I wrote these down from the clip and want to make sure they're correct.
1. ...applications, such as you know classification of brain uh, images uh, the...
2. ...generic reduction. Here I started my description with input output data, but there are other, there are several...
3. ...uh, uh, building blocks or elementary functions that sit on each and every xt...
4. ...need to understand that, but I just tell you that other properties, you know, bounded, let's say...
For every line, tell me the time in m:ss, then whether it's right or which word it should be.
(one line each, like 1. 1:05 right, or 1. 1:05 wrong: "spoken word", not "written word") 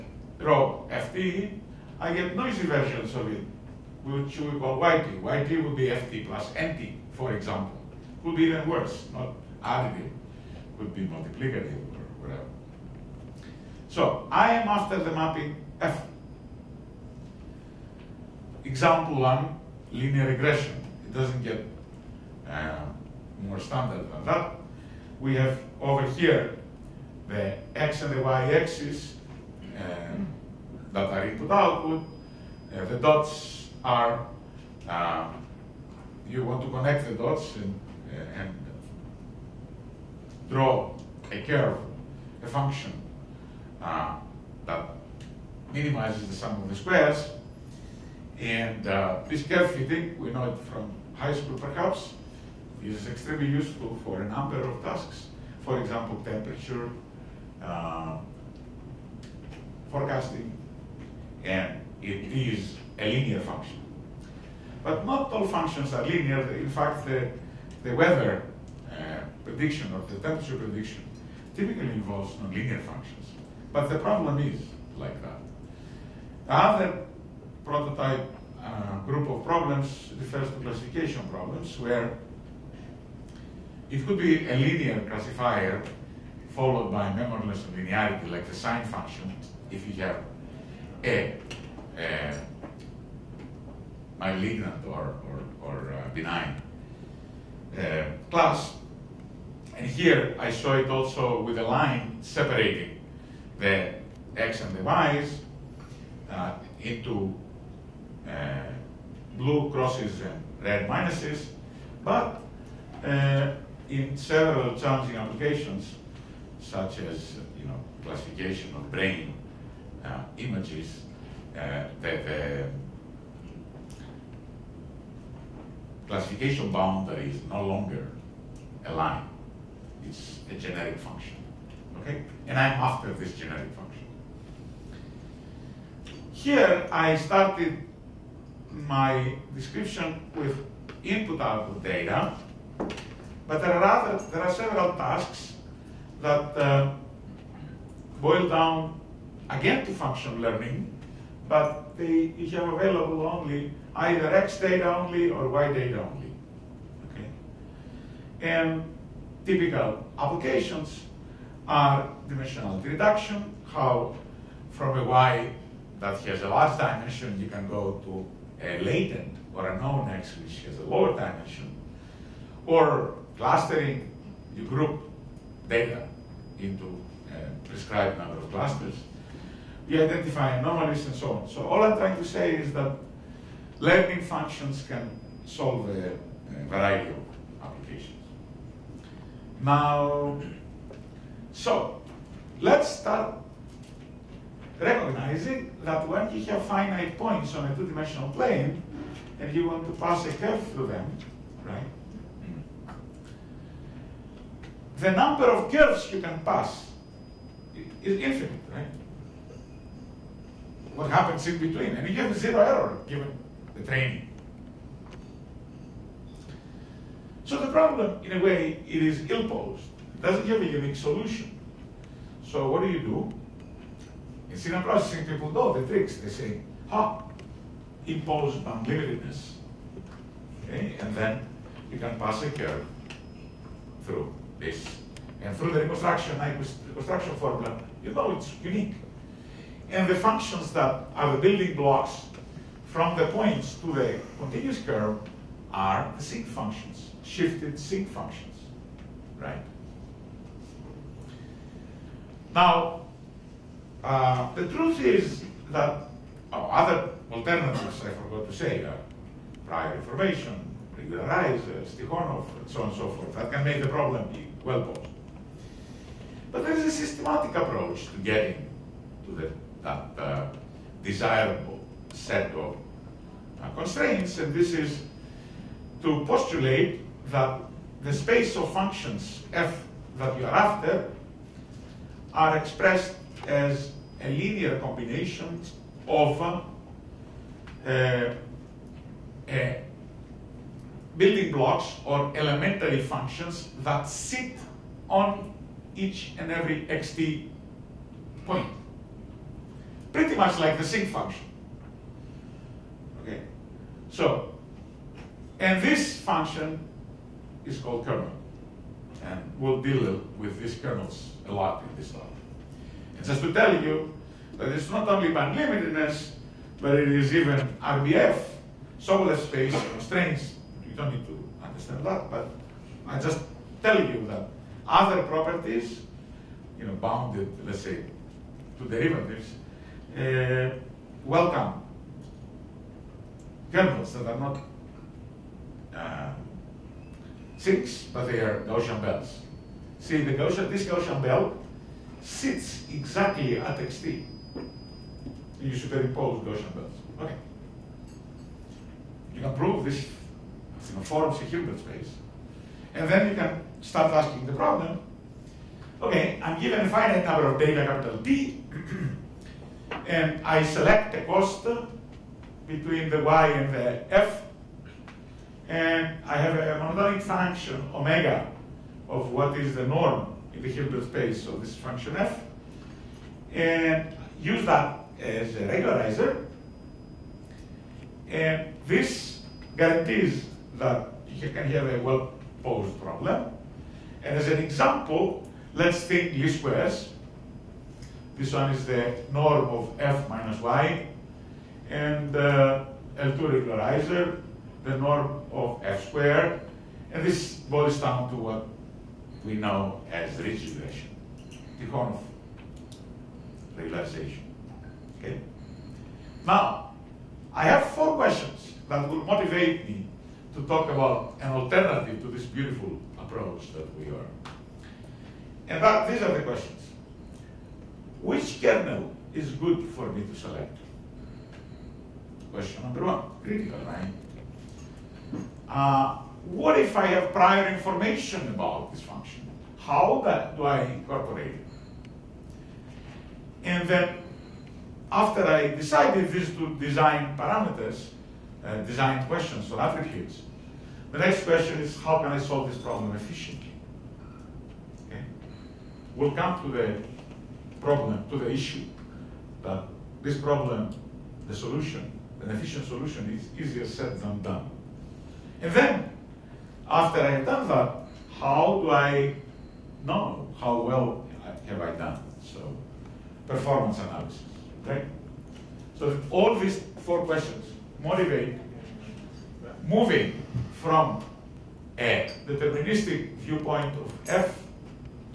1. 1:55 right
2. 2:13 wrong: "function", not "reduction"
3. 4:46 right
4. 5:21 right.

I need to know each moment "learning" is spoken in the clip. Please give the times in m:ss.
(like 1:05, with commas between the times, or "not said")
2:30, 3:03.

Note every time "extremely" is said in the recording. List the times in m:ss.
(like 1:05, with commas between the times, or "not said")
0:53.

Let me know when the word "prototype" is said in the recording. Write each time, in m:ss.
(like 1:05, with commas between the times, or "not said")
1:17.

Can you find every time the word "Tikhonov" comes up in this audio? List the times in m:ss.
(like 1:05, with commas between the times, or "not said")
4:21, 6:41.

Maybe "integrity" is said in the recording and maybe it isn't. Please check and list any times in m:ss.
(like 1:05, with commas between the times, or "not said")
not said.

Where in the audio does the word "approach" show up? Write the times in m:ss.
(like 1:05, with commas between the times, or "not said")
4:27, 6:53.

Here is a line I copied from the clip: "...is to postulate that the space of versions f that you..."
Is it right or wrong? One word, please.
wrong.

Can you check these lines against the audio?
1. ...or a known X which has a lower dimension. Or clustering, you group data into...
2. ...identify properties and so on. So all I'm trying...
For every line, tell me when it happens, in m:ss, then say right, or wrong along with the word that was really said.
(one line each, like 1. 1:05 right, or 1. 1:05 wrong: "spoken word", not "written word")
1. 2:49 right
2. 3:00 wrong: "anomalies", not "properties".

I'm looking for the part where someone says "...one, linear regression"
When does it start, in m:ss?
0:19.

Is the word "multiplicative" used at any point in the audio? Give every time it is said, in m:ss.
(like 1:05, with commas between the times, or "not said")
0:11.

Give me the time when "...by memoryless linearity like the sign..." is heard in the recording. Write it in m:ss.
1:26.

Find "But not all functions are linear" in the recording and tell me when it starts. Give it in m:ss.
1:04.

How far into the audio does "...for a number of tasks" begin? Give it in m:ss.
0:54.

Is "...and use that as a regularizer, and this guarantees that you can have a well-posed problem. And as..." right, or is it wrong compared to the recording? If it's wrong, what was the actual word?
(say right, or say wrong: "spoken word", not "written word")
right.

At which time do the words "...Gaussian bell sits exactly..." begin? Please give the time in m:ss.
5:40.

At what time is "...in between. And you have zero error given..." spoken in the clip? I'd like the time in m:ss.
3:31.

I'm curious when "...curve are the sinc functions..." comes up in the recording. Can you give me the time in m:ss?
4:04.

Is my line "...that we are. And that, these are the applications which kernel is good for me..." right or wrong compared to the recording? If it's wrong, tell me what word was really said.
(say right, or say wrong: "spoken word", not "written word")
wrong: "questions", not "applications".